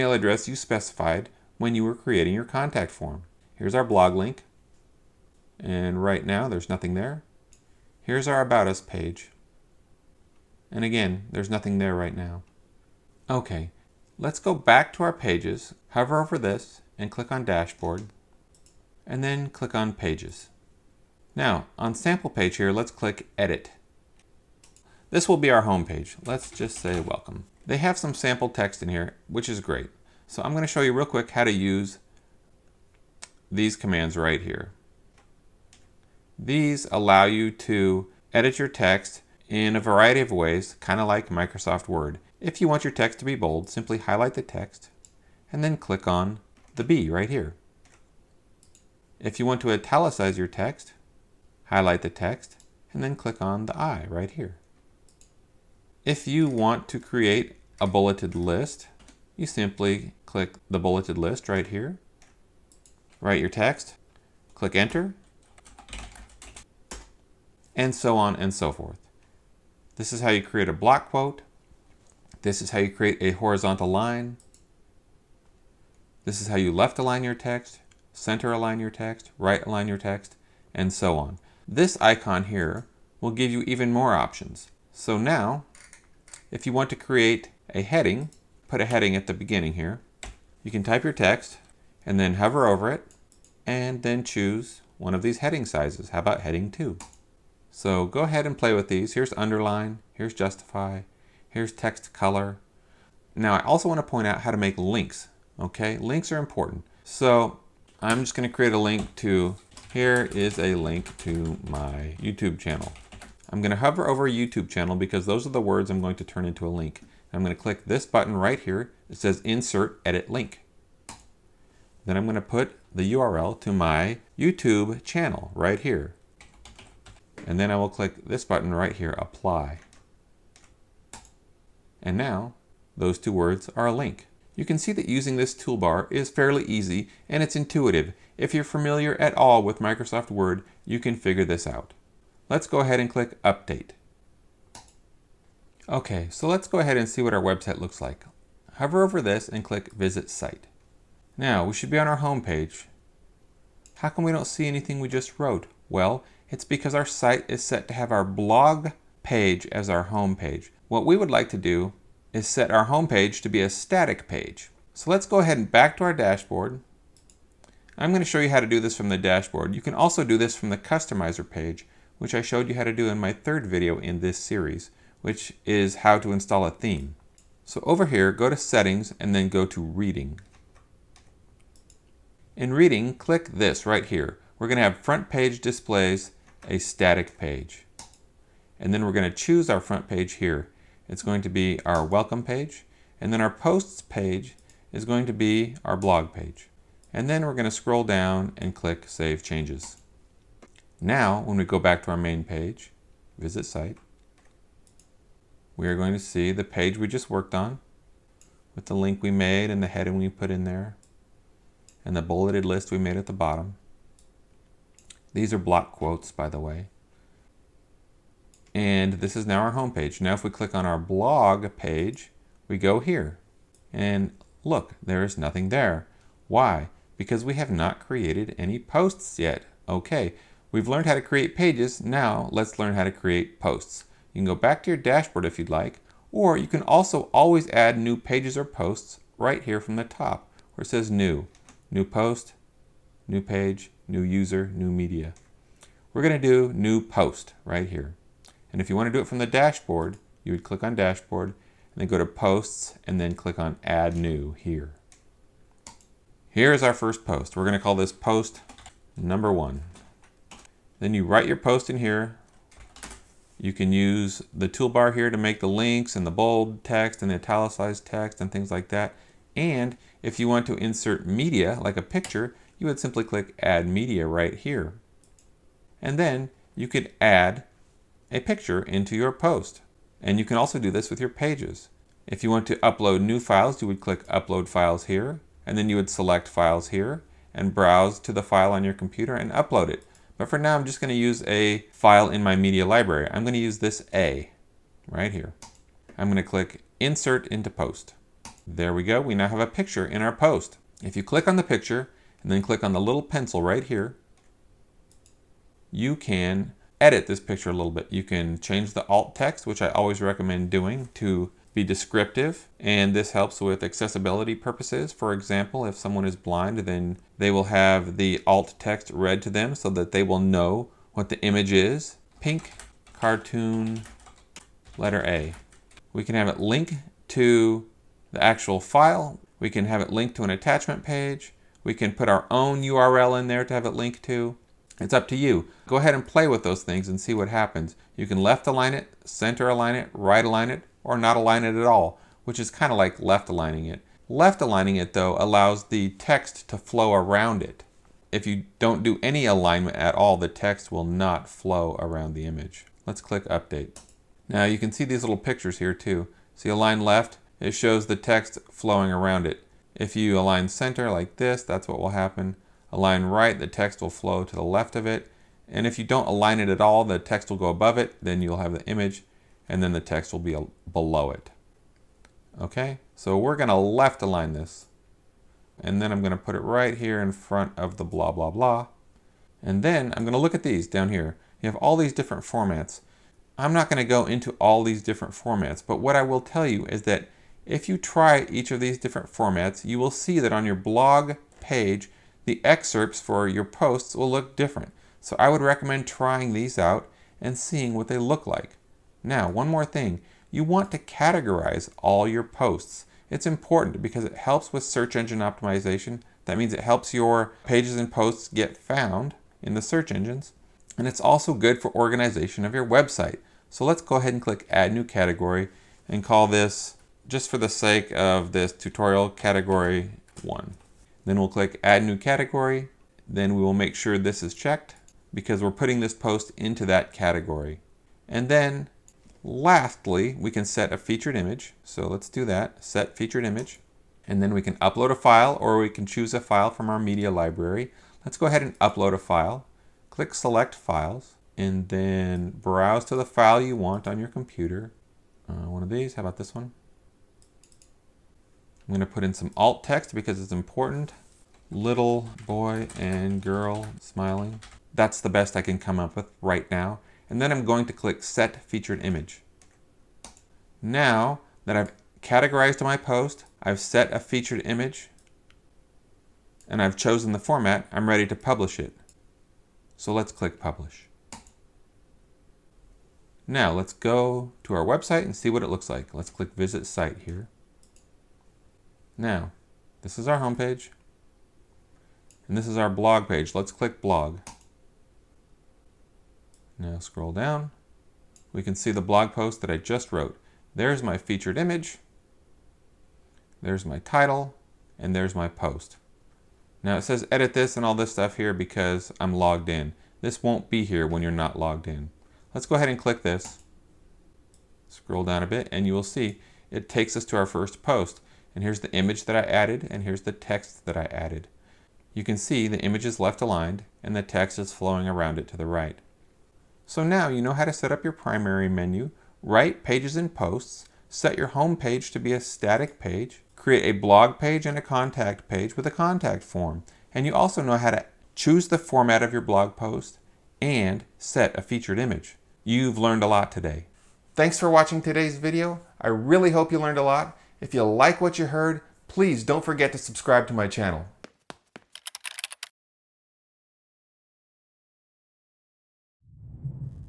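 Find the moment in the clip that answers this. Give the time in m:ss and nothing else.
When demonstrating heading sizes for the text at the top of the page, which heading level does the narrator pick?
1:36.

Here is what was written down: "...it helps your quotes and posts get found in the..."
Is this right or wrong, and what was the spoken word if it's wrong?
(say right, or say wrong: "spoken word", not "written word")
wrong: "pages", not "quotes".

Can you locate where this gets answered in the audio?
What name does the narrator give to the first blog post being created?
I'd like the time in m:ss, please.
4:18.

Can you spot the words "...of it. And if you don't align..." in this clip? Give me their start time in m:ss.
6:04.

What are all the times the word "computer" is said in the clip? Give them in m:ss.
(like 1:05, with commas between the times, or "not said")
4:48, 7:24.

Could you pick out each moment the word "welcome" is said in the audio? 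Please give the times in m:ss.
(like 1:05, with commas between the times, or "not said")
0:27, 3:12.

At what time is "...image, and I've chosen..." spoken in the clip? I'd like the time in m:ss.
7:44.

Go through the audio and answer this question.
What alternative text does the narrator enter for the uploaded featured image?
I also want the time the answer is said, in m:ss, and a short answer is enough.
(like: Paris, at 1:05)
Little boy and girl smiling, at 7:31.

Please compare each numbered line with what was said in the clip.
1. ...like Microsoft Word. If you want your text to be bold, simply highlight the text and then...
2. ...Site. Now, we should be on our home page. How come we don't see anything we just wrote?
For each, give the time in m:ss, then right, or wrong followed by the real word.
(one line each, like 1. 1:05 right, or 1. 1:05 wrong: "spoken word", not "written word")
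1. 0:41 right
2. 2:30 right.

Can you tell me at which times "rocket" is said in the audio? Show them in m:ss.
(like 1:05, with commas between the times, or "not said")
not said.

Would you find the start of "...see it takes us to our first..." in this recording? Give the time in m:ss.
8:26.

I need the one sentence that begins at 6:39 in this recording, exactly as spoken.
Now, one more thing, you want to categorize all your posts.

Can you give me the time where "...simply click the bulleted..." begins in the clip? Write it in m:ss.
0:59.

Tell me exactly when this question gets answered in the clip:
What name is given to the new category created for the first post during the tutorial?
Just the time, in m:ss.
6:59.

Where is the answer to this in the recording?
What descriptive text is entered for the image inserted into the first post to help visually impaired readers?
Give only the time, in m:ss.
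5:22.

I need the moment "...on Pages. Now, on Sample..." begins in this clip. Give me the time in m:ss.
0:19.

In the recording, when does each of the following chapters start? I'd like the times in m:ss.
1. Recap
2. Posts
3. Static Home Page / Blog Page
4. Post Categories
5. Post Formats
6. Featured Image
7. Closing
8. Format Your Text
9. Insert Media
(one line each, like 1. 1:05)
1. 8:36
2. 4:01
3. 2:30
4. 6:39
5. 6:19
6. 7:08
7. 8:53
8. 0:13
9. 4:29.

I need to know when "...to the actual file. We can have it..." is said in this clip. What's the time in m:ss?
5:27.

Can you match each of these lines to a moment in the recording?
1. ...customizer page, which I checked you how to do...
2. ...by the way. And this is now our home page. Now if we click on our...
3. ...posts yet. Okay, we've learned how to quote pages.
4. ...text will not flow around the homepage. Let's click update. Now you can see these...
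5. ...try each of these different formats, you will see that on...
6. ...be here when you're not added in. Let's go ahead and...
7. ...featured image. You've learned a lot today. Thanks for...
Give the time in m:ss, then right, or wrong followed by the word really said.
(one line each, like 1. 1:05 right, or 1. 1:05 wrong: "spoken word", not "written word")
1. 2:50 wrong: "showed", not "checked"
2. 3:36 right
3. 3:48 wrong: "create", not "quote"
4. 5:50 wrong: "image", not "homepage"
5. 6:27 right
6. 8:20 wrong: "logged", not "added"
7. 8:51 right.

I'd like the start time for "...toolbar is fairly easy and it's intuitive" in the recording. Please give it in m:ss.
2:15.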